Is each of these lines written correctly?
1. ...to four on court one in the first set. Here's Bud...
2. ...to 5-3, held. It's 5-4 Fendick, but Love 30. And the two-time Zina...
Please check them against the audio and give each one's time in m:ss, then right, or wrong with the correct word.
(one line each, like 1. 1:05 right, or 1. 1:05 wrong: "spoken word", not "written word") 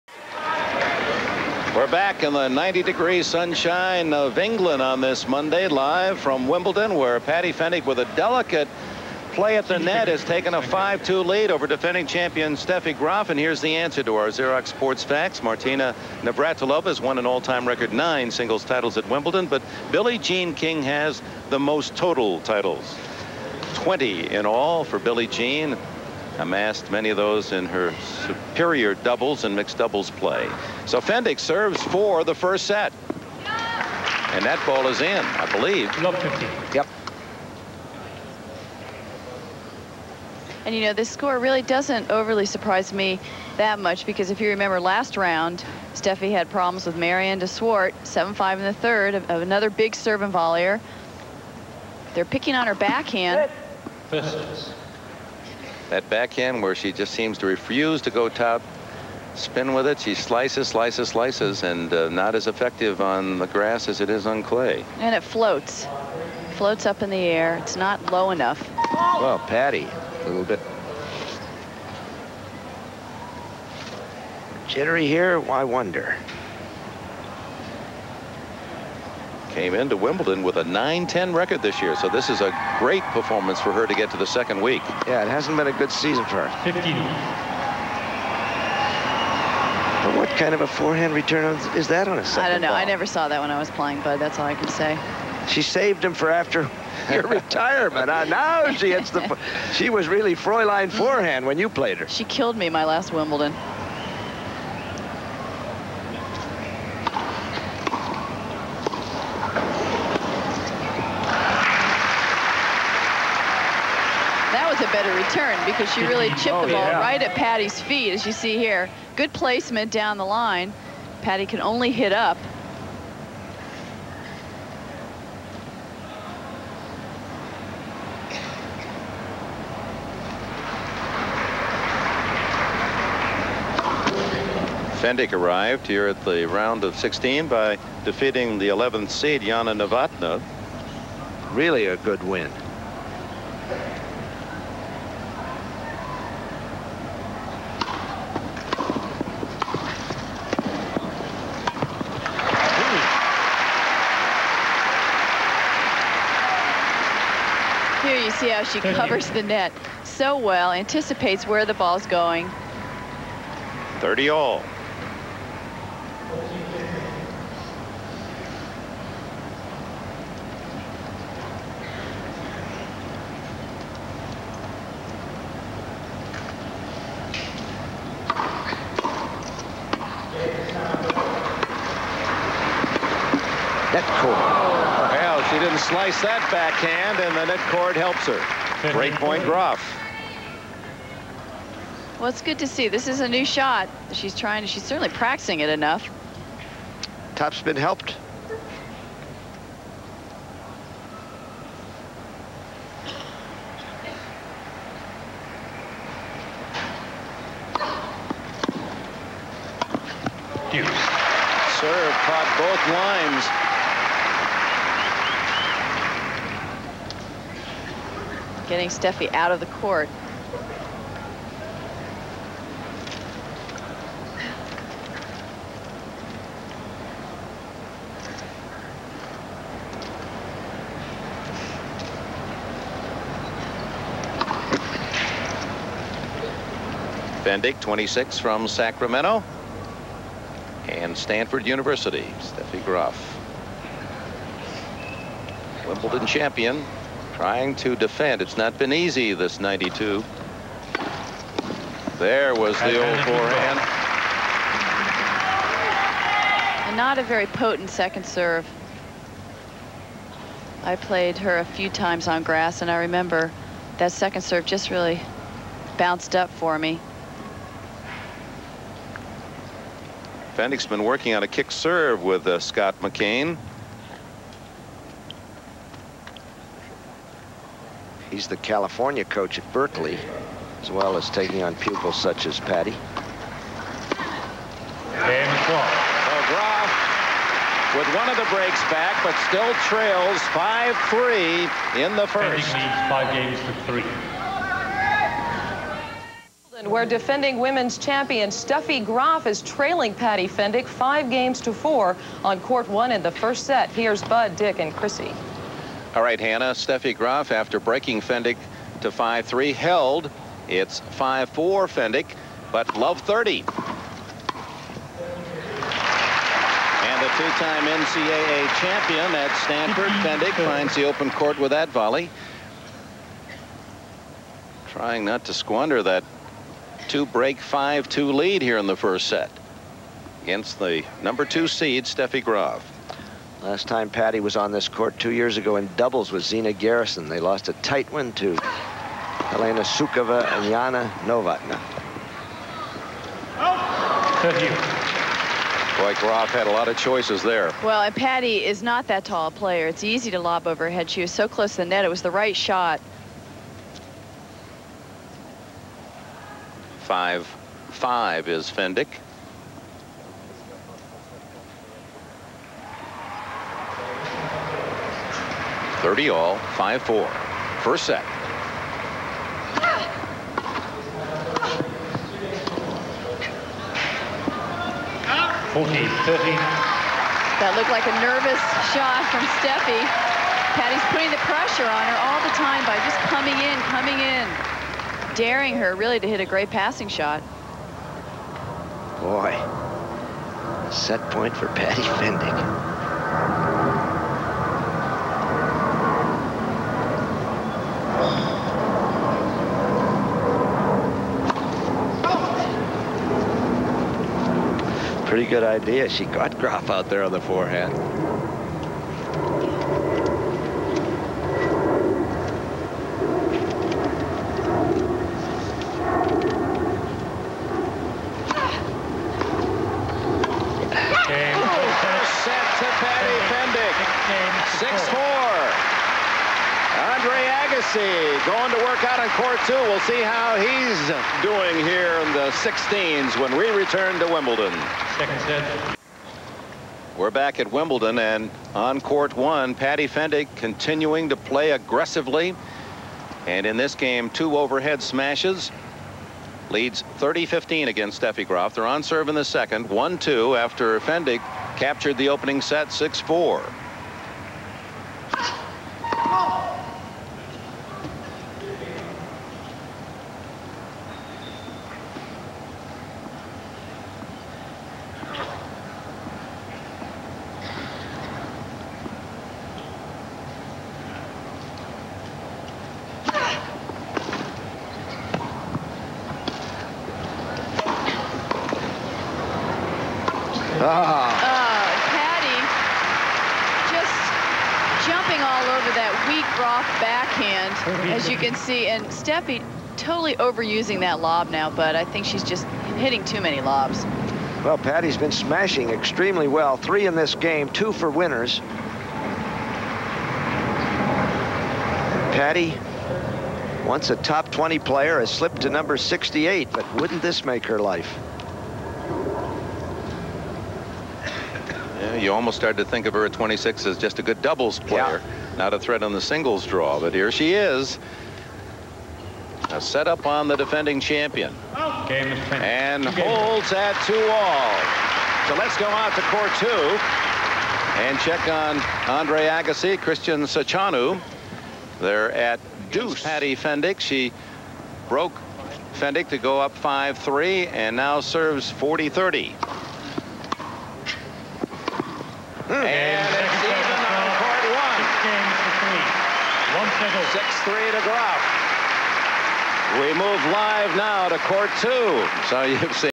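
1. 5:01 right
2. 5:08 wrong: "NCAA", not "Zina".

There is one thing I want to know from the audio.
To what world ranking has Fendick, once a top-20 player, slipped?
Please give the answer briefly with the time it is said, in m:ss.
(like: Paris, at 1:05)
68, at 8:25.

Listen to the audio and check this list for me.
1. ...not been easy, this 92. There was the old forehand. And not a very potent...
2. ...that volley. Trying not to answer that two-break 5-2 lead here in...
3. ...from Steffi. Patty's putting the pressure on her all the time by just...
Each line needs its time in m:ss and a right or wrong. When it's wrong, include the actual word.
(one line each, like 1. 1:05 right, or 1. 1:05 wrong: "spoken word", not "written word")
1. 4:08 right
2. 5:21 wrong: "squander", not "answer"
3. 6:19 right.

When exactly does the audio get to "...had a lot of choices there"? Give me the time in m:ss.
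5:46.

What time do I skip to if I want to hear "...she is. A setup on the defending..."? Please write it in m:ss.
8:37.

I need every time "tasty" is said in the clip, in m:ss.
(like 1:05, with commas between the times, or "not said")
not said.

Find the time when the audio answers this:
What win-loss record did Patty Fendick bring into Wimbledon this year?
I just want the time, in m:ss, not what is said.
1:20.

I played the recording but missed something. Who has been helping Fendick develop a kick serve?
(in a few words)
Scott McCain.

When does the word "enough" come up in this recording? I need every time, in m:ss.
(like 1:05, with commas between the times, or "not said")
1:08, 3:15.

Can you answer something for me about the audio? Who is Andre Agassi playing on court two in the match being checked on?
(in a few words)
Christian Saceanu.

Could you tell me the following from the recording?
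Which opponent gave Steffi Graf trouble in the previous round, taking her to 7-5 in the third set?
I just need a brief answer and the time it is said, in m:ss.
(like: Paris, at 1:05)
Mariaan de Swardt, at 0:46.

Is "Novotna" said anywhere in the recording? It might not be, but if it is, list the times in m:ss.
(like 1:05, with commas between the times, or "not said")
2:19, 5:41.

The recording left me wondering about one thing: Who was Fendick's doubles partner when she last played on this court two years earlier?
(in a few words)
Zina Garrison.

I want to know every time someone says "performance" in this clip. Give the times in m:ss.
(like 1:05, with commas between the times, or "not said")
1:23.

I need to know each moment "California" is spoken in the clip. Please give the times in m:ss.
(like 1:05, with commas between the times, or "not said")
4:38.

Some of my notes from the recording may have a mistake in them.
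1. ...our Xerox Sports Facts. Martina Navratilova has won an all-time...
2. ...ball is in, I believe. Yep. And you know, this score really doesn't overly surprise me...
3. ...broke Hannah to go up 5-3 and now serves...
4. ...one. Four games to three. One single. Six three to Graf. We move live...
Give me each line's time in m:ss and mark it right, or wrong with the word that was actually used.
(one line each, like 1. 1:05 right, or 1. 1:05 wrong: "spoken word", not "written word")
1. 0:14 right
2. 0:34 right
3. 8:55 wrong: "Fendick", not "Hannah"
4. 9:04 wrong: "Six", not "Four".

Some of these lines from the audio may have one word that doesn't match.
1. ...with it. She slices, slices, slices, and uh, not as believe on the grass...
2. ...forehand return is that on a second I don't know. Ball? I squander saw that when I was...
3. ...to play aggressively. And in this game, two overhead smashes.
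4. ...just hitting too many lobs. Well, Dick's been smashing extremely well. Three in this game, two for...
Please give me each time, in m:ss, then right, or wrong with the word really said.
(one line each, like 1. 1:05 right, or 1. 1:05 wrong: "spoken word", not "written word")
1. 0:59 wrong: "effective", not "believe"
2. 1:30 wrong: "never", not "squander"
3. 7:21 right
4. 8:12 wrong: "Patty", not "Dick".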